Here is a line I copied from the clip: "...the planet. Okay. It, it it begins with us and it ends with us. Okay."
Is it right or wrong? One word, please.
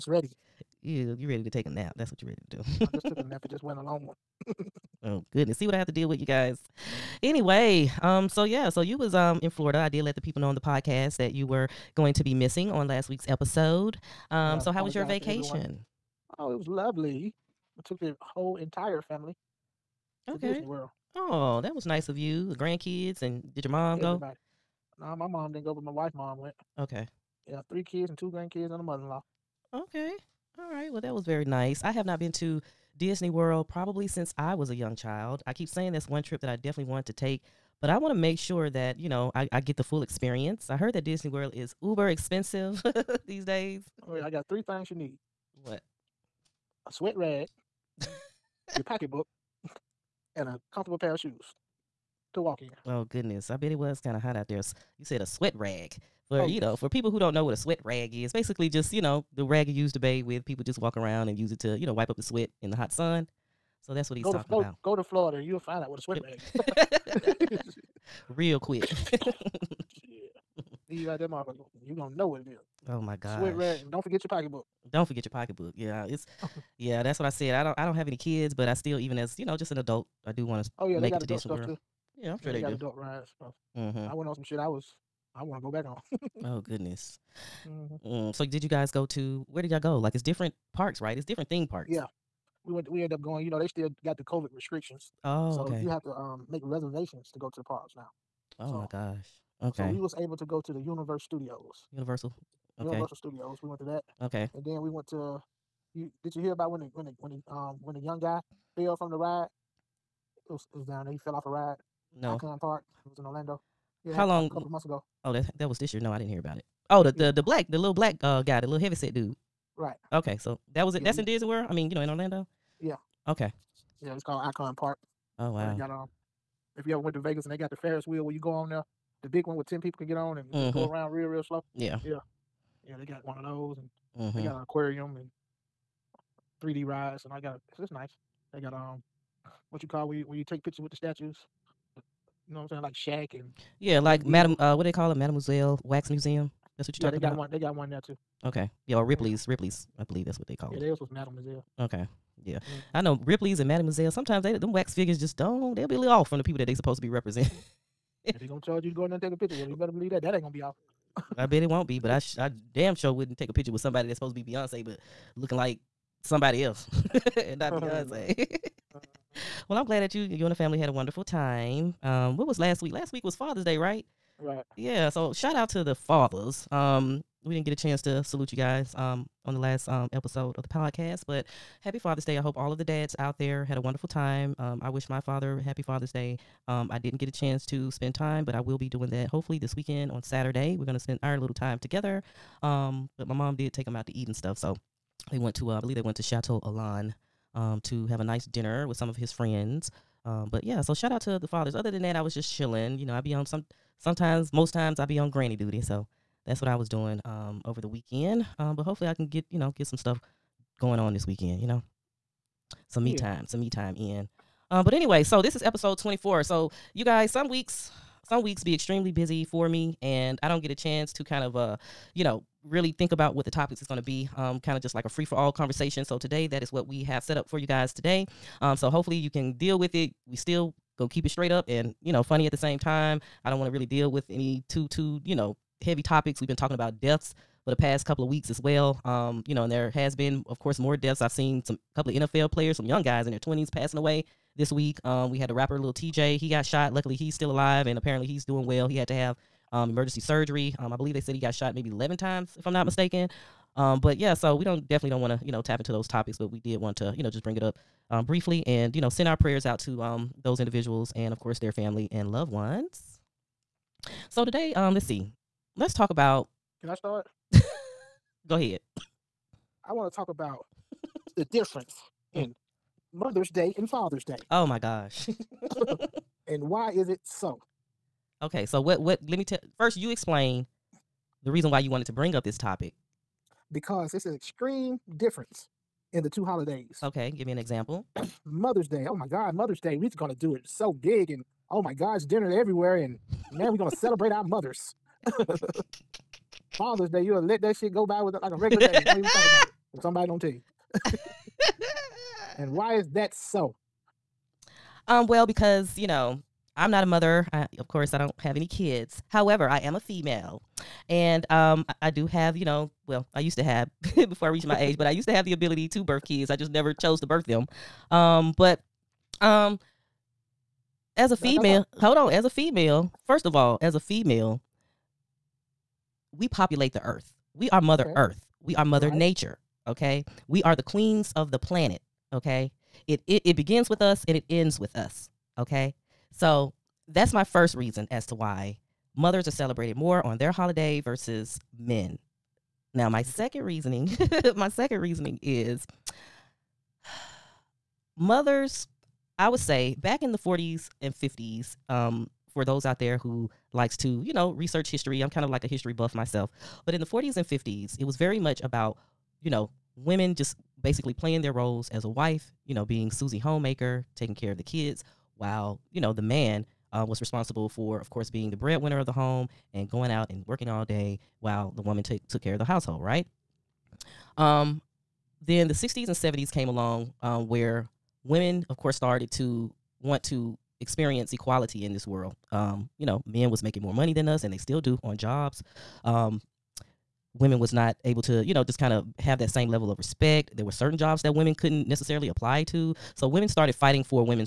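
right.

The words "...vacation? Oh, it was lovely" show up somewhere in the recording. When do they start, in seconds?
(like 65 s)
15 s.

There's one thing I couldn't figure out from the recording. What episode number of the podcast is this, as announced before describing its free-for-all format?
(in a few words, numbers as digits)
24.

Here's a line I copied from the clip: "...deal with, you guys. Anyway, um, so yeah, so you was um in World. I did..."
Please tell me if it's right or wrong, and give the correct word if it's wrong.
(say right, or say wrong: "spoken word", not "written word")
wrong: "Florida", not "World".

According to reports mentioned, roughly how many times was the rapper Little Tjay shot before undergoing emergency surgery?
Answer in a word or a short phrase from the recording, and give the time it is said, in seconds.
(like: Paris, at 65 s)
11, at 251 s.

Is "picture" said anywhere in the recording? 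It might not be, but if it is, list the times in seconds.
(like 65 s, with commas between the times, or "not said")
140 s, 159 s, 163 s.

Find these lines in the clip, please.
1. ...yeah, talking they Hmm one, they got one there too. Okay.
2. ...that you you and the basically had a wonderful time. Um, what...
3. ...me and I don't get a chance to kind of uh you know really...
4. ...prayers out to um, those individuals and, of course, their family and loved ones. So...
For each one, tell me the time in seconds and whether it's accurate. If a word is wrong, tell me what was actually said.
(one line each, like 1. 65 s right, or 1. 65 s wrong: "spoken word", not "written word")
1. 147 s wrong: "Got", not "Hmm"
2. 170 s wrong: "family", not "basically"
3. 219 s right
4. 259 s right.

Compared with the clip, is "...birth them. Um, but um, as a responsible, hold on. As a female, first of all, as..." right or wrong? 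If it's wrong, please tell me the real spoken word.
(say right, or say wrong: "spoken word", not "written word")
wrong: "female", not "responsible".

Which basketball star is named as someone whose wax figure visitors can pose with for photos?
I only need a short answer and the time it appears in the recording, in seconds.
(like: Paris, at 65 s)
Shaq, at 142 s.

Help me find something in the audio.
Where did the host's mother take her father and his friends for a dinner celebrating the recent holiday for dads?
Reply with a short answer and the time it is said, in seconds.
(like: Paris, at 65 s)
Chateau Elan, at 196 s.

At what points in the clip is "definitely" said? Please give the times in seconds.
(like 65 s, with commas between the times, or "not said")
36 s, 254 s.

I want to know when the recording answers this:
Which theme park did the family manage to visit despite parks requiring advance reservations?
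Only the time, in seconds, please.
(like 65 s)
102 s.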